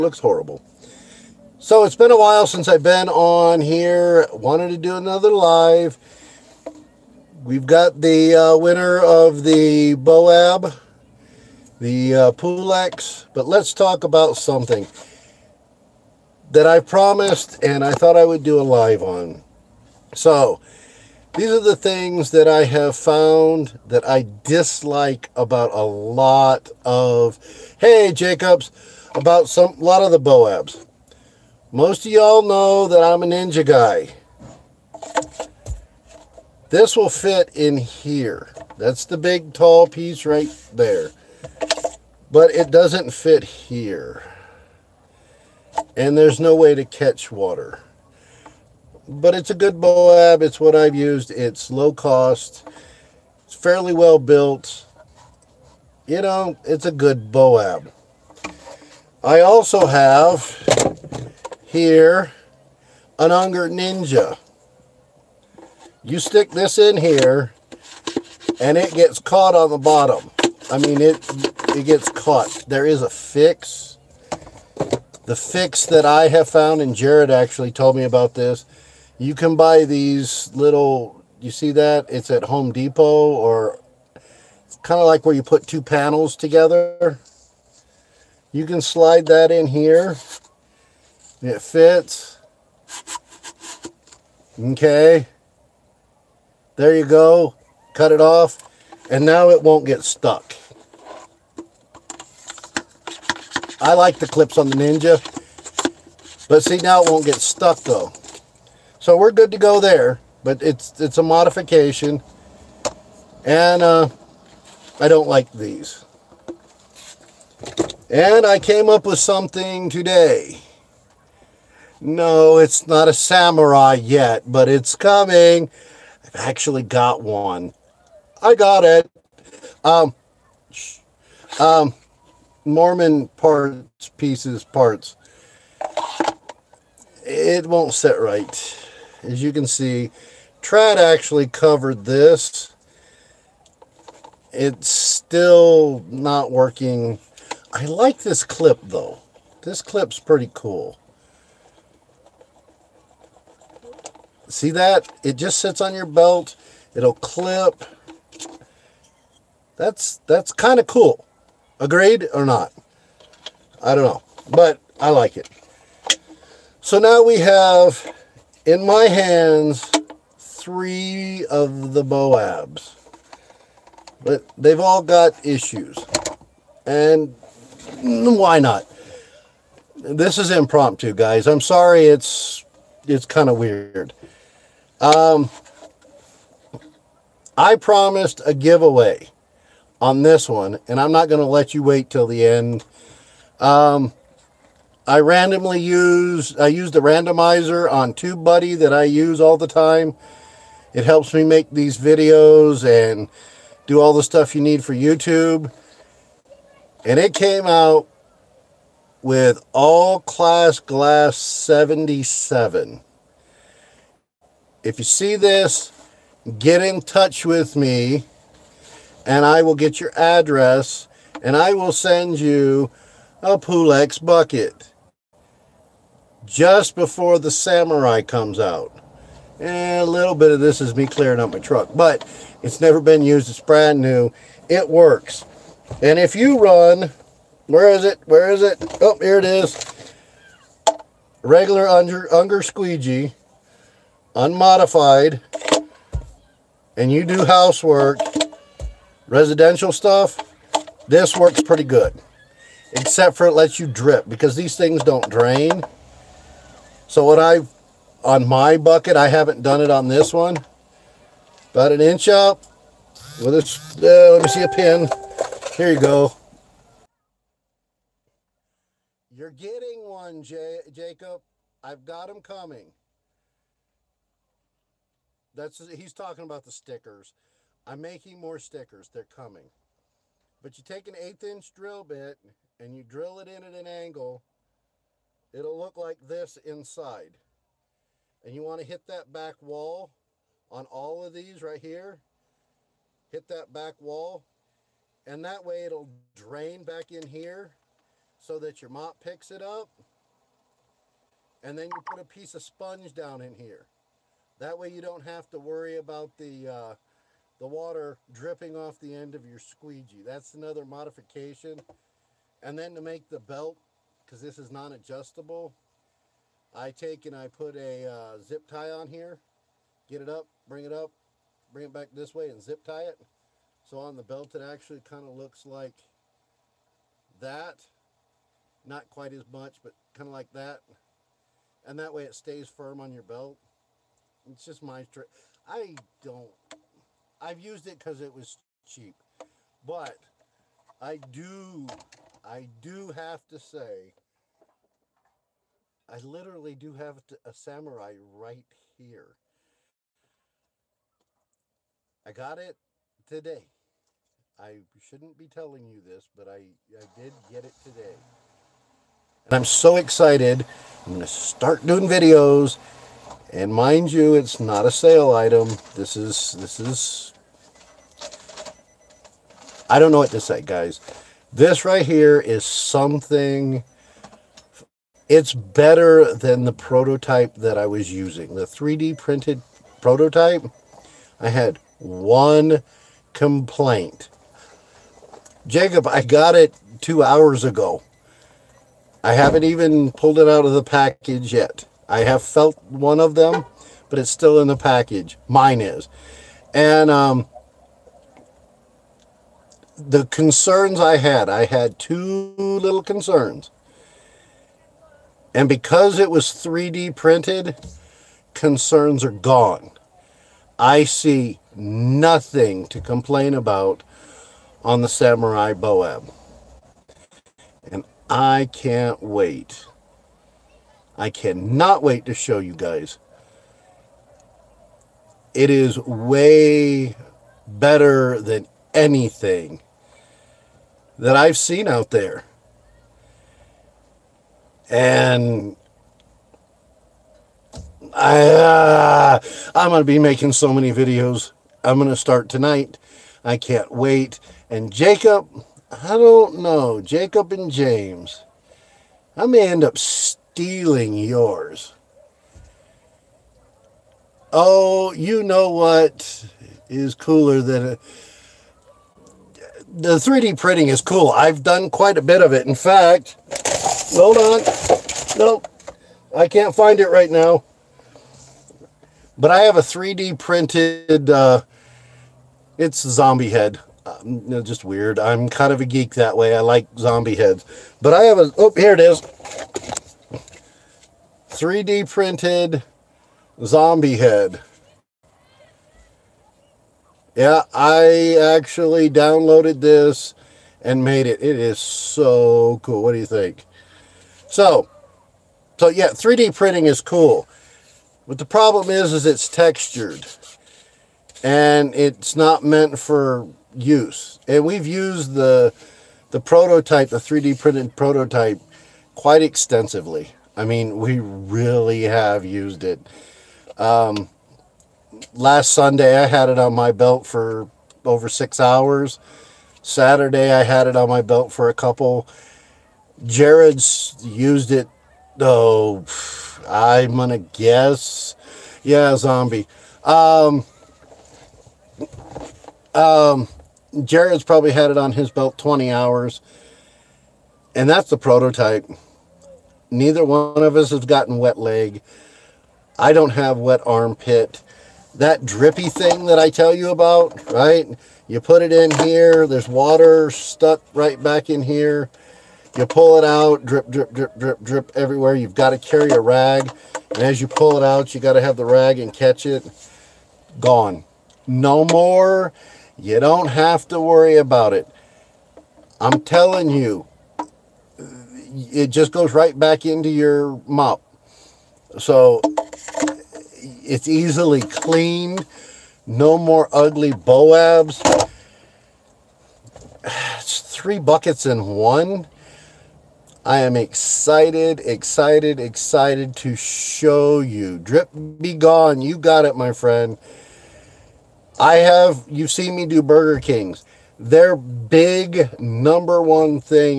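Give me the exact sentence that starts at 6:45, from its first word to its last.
And because it was 3D printed, concerns are gone.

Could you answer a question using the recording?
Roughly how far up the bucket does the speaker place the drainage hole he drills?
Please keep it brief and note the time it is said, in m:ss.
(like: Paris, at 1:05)
About an inch, at 4:21.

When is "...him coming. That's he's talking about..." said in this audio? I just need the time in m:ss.
4:32.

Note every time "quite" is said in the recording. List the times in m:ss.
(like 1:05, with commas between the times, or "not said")
5:29, 7:41, 8:29.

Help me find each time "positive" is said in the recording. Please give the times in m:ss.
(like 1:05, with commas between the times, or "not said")
not said.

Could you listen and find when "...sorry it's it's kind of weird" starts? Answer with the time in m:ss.
3:01.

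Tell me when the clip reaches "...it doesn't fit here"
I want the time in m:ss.
0:42.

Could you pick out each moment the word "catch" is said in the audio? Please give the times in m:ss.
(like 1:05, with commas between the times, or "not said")
0:46, 9:19.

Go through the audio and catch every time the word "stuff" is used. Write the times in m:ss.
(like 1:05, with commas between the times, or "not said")
3:24, 4:09.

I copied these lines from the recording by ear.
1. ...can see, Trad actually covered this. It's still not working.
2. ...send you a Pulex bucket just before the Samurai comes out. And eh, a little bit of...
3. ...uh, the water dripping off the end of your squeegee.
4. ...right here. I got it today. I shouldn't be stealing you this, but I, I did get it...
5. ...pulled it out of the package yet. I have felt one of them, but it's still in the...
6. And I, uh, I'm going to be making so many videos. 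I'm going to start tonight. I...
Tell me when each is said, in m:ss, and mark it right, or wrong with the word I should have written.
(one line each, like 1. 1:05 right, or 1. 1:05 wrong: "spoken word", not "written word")
1. 2:19 right
2. 3:41 right
3. 5:06 right
4. 5:48 wrong: "telling", not "stealing"
5. 6:30 right
6. 7:14 right.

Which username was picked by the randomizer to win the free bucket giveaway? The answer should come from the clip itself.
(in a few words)
all class glass 77.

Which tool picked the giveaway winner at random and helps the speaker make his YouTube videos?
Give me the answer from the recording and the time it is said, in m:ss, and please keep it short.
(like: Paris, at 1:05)
TubeBuddy, at 3:18.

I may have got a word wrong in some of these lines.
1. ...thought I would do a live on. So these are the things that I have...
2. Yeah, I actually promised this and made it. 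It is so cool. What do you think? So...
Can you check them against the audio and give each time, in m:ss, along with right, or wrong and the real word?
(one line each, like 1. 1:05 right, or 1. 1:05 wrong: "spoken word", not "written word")
1. 0:17 right
2. 8:07 wrong: "downloaded", not "promised".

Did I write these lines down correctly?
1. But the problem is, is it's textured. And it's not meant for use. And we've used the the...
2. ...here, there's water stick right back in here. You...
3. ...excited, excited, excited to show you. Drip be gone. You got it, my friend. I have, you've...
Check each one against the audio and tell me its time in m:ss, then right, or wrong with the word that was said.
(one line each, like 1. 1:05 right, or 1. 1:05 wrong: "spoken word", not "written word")
1. 8:18 right
2. 9:09 wrong: "stuck", not "stick"
3. 9:43 right.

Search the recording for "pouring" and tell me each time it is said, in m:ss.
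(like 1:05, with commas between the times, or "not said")
not said.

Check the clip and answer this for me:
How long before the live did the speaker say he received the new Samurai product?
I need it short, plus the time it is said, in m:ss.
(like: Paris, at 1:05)
2 hours, at 6:27.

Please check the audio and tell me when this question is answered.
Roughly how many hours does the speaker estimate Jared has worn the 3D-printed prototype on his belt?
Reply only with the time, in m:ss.
8:55.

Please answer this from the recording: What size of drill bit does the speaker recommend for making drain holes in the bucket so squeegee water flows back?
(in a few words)
eighth inch.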